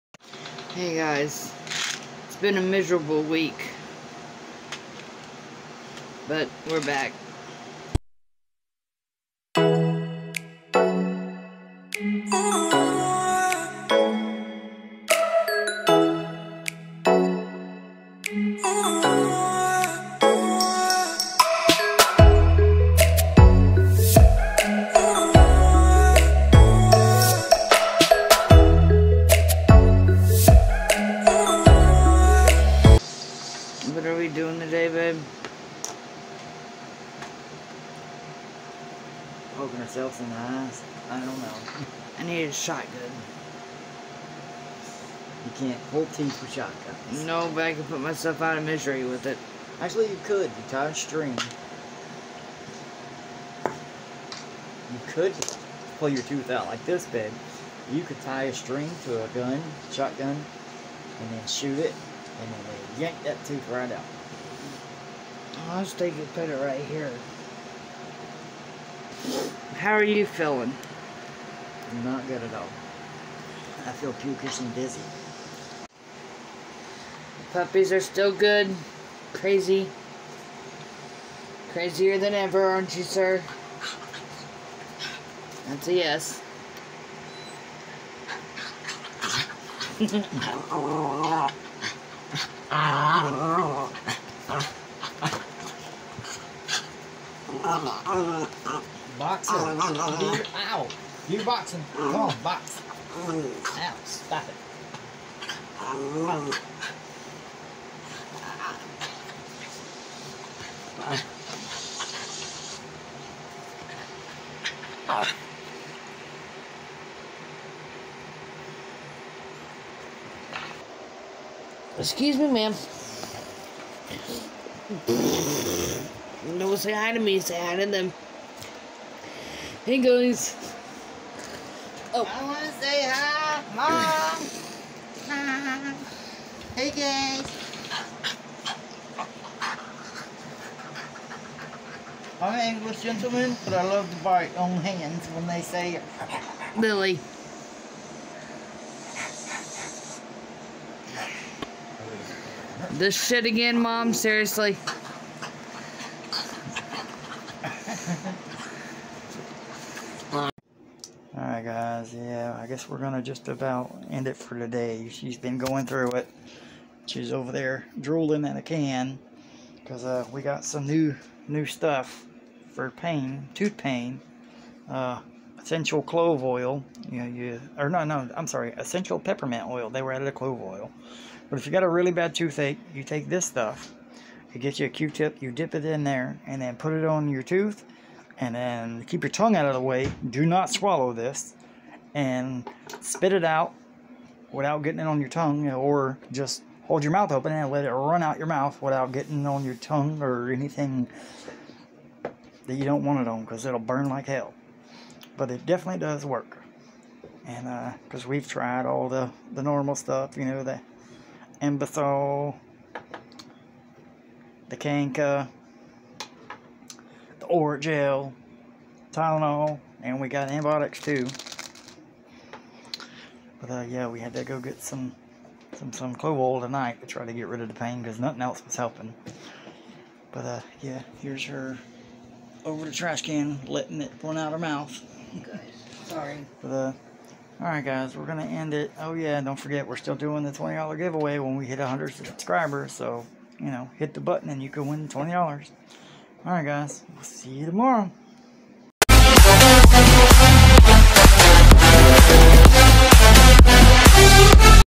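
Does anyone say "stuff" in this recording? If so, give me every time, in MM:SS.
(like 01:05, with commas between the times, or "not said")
02:51, 03:03, 03:29.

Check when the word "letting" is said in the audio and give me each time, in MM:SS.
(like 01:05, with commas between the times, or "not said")
03:53.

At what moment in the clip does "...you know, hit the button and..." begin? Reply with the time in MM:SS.
04:03.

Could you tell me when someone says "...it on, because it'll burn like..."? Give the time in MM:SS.
03:23.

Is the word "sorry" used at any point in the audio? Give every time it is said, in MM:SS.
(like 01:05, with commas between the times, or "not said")
02:58, 03:56.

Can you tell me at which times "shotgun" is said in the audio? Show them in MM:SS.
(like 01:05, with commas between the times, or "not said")
00:42, 00:46, 00:59.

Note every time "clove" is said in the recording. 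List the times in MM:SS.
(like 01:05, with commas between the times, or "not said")
02:56, 03:00, 03:46.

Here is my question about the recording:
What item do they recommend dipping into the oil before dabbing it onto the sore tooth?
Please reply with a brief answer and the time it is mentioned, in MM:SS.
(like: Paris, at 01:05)
Q-tip, at 03:04.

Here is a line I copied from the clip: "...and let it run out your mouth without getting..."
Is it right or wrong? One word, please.
right.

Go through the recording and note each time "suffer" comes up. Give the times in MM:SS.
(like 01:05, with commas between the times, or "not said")
not said.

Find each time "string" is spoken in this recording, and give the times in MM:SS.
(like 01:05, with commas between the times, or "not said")
00:50, 00:58.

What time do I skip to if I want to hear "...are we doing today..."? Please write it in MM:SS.
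00:34.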